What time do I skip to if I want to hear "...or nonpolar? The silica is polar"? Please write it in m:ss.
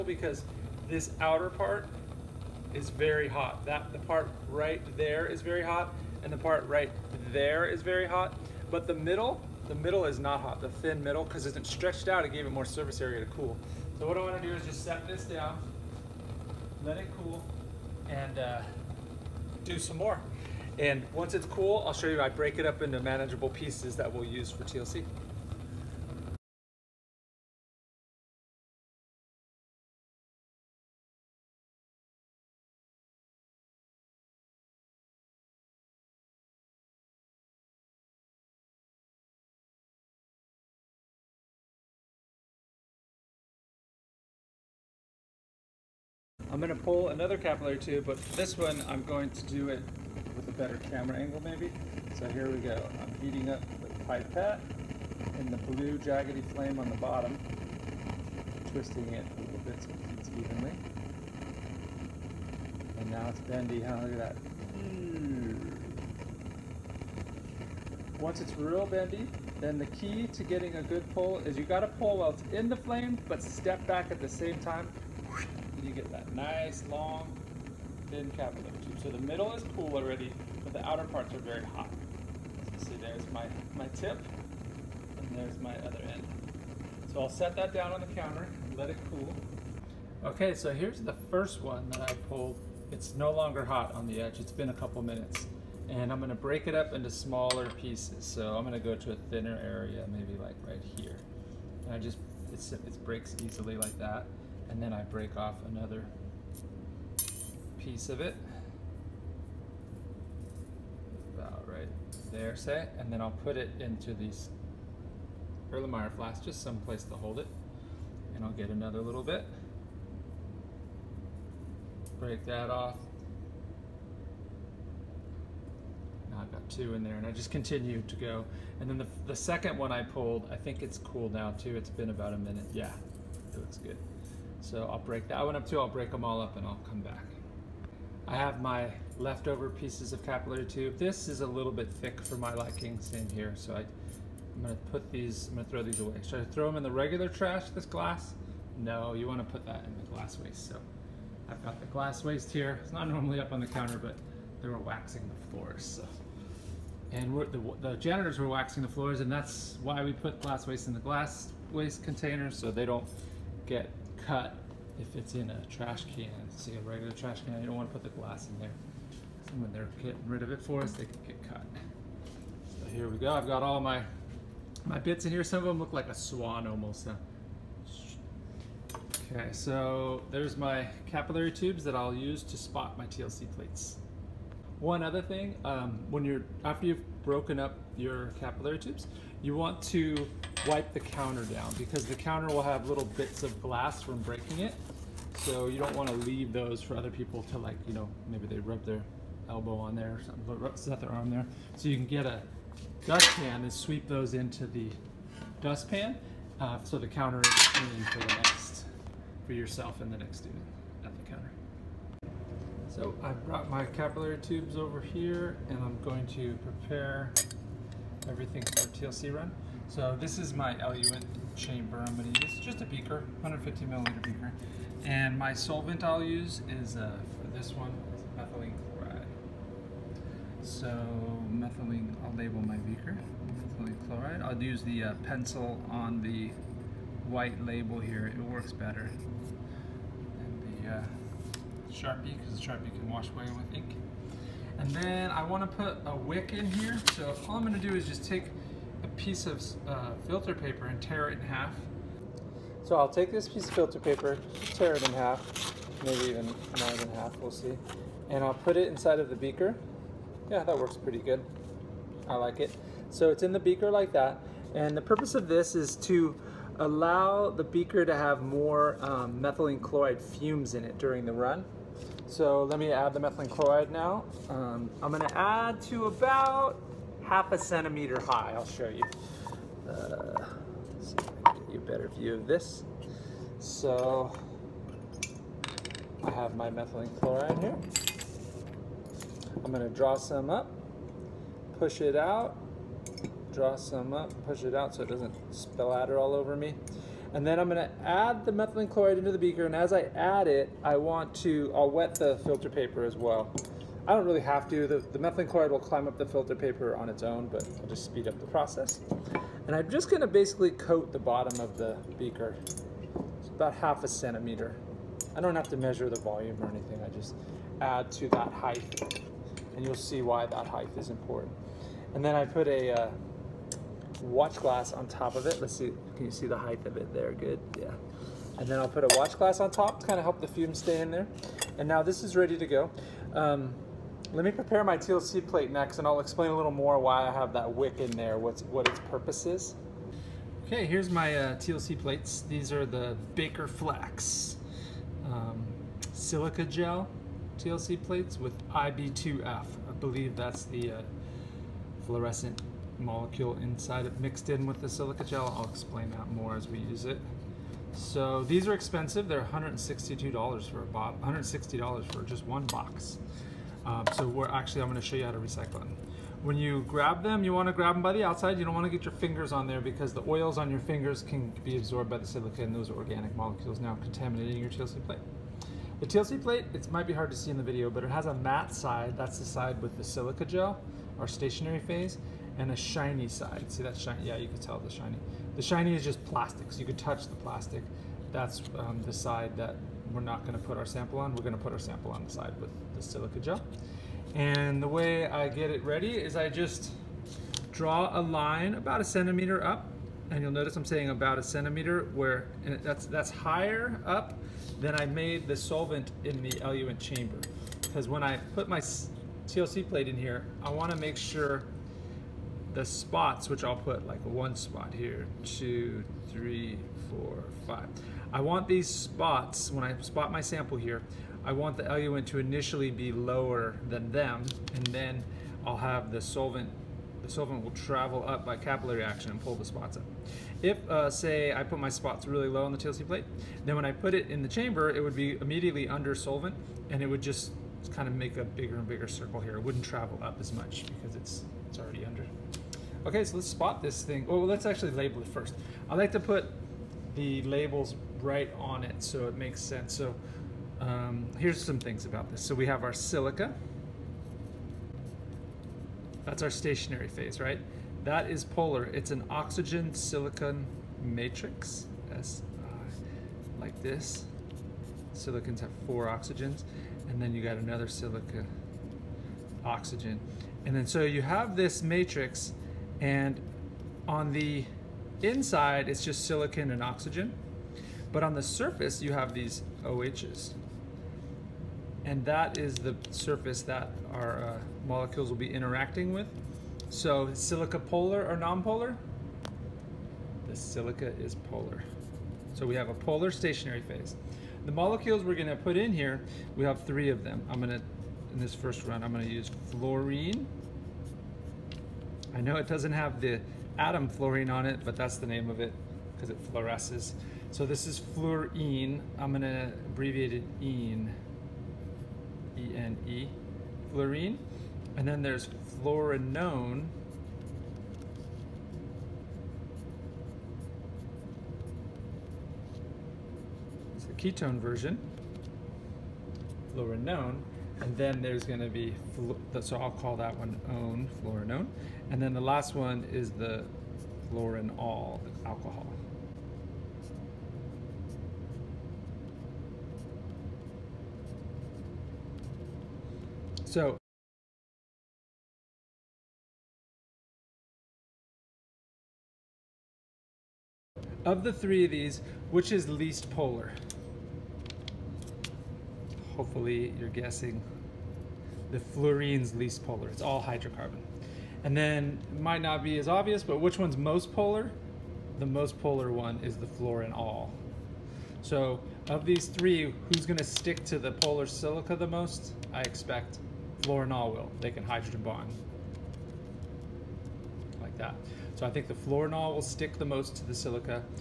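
8:08.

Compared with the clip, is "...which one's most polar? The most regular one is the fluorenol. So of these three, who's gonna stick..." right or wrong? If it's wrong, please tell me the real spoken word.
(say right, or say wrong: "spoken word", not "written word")
wrong: "polar", not "regular".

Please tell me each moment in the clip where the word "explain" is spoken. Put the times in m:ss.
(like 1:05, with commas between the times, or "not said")
5:36, 5:55.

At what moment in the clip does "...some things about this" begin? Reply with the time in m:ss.
7:31.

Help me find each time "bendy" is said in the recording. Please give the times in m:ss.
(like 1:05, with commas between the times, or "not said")
1:03, 1:08.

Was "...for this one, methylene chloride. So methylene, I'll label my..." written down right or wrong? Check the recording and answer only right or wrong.
right.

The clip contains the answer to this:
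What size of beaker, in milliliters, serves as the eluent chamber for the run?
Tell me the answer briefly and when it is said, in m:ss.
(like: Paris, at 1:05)
150, at 3:43.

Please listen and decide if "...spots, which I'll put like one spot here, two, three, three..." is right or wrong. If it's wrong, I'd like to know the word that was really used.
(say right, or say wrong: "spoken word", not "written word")
wrong: "four", not "three".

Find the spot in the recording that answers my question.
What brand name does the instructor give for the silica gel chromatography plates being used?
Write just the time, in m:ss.
5:43.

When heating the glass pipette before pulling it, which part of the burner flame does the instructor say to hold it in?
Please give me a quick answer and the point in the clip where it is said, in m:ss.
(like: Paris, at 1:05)
Blue jaggedy flame, at 0:55.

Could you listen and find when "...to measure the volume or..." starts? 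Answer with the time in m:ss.
5:15.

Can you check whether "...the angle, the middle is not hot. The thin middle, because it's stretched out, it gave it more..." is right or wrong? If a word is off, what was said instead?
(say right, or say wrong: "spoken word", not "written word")
wrong: "middle", not "angle".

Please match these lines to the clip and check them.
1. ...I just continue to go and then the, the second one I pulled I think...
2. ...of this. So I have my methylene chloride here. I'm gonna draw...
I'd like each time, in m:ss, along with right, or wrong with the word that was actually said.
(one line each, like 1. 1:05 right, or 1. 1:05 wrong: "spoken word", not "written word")
1. 2:07 right
2. 4:42 right.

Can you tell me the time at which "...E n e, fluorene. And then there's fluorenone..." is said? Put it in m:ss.
8:32.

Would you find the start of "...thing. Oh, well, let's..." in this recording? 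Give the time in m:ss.
7:24.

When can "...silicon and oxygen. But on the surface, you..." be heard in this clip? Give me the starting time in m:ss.
7:56.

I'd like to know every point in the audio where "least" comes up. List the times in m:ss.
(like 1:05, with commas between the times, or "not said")
9:12, 9:19.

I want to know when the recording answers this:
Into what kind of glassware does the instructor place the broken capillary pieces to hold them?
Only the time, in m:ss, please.
1:55.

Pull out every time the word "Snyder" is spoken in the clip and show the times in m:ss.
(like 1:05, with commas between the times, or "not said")
not said.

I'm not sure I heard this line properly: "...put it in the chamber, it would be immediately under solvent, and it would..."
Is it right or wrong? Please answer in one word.
right.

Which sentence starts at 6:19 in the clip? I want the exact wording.
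That's the side with the silica gel, our stationary phase and a shiny side.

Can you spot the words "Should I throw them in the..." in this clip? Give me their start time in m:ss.
2:26.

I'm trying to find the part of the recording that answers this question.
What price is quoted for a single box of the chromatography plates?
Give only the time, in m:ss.
5:59.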